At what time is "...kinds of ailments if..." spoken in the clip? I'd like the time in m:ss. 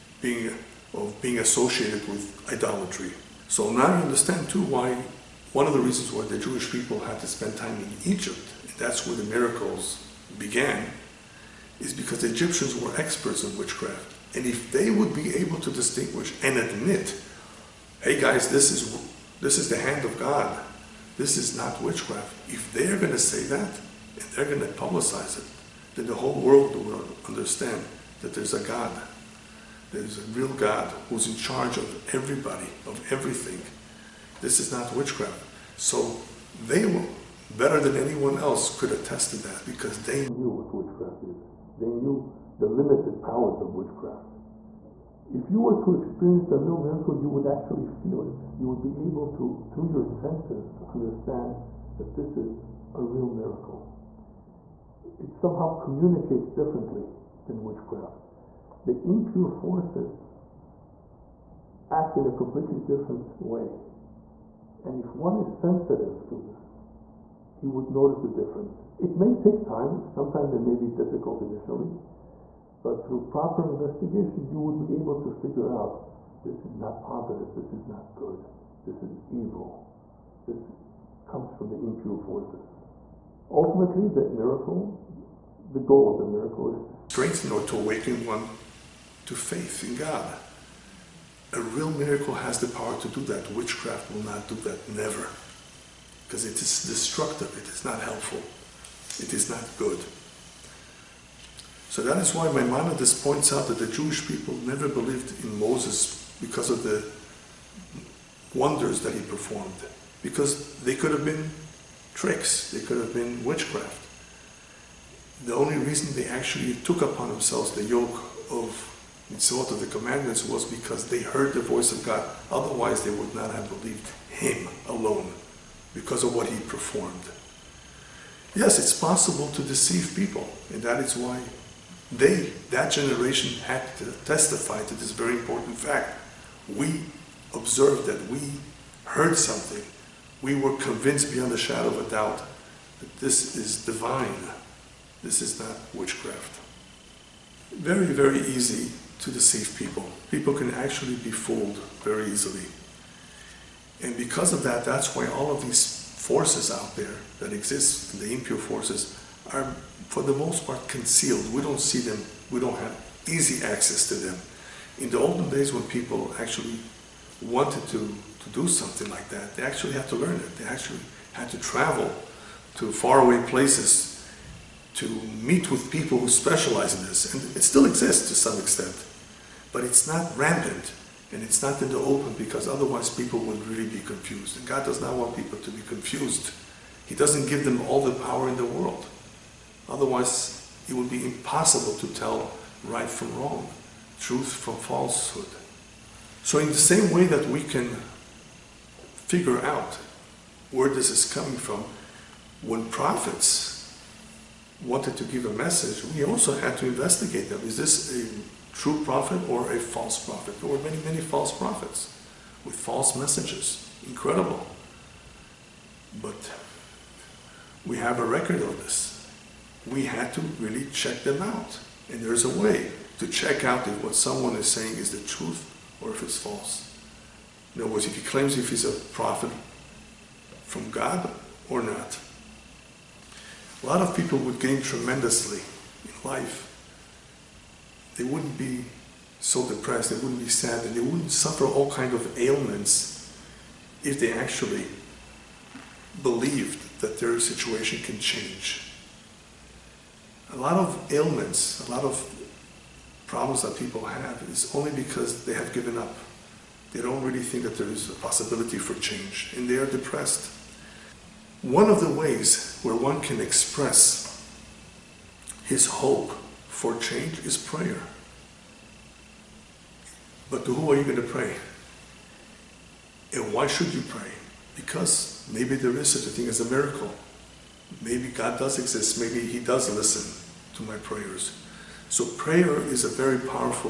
4:01.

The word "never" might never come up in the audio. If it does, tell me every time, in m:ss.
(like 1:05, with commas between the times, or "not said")
1:34, 1:44.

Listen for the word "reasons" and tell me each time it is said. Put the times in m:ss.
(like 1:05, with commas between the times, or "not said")
0:05, 1:55.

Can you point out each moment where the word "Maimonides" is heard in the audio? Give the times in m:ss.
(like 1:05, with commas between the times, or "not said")
1:42.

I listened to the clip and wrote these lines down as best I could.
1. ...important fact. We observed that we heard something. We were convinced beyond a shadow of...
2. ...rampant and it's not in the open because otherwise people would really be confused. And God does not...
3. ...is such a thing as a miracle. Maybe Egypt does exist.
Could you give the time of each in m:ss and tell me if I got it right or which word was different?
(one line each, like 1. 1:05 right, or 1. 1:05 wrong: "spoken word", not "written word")
1. 2:15 right
2. 3:00 right
3. 4:35 wrong: "God", not "Egypt".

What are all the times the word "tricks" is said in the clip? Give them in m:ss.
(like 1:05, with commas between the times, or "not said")
1:52.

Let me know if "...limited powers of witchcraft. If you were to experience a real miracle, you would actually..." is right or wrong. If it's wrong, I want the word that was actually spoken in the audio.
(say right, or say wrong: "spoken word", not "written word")
right.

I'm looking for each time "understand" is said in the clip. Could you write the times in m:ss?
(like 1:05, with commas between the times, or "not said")
0:04, 0:27, 0:50.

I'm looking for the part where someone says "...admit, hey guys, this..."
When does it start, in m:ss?
0:16.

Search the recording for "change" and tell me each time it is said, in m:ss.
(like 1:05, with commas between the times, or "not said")
4:08, 4:19, 4:26.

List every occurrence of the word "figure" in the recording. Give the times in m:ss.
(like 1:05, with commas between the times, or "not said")
1:15, 3:19.